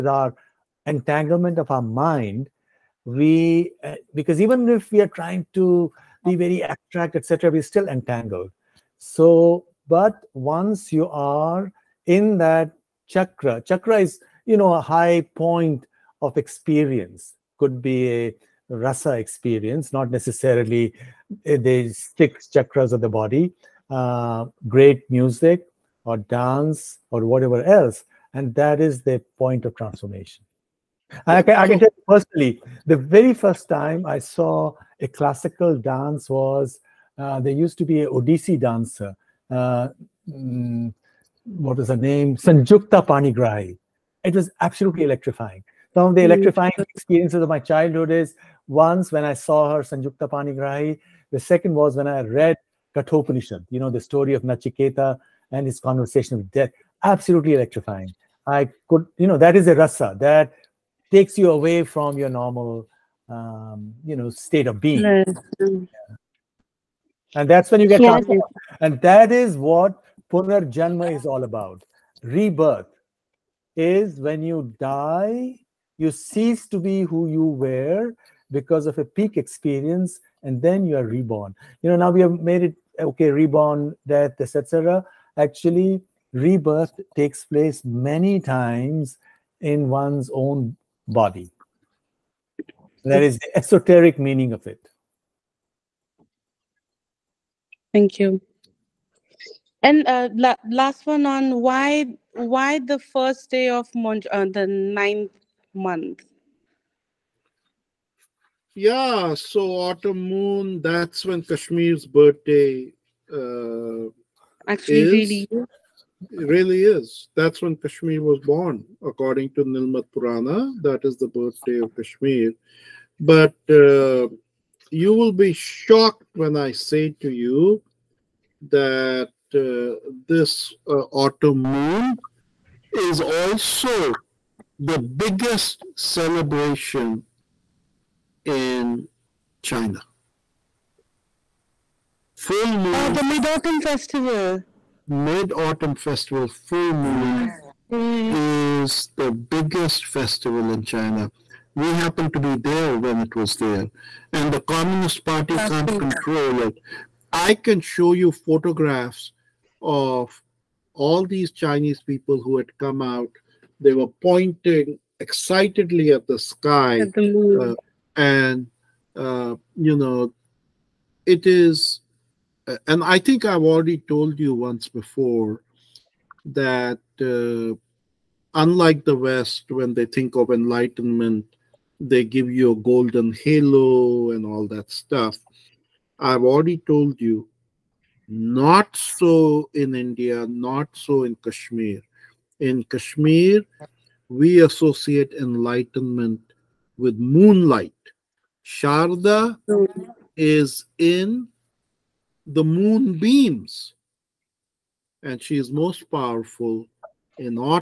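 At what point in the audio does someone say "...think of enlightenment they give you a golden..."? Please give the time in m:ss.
3:00.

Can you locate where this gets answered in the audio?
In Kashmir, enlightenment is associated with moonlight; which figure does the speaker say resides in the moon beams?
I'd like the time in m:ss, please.
3:18.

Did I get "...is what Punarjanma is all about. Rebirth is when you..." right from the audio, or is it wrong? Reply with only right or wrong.
right.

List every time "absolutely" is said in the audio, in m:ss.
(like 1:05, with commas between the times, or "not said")
0:44, 0:57.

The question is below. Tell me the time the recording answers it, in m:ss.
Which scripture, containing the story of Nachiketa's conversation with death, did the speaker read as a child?
0:52.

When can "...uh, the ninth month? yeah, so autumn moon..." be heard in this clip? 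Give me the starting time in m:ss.
1:44.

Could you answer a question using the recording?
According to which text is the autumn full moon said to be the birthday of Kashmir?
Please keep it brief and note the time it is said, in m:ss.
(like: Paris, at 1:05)
Nilmat Purana, at 1:59.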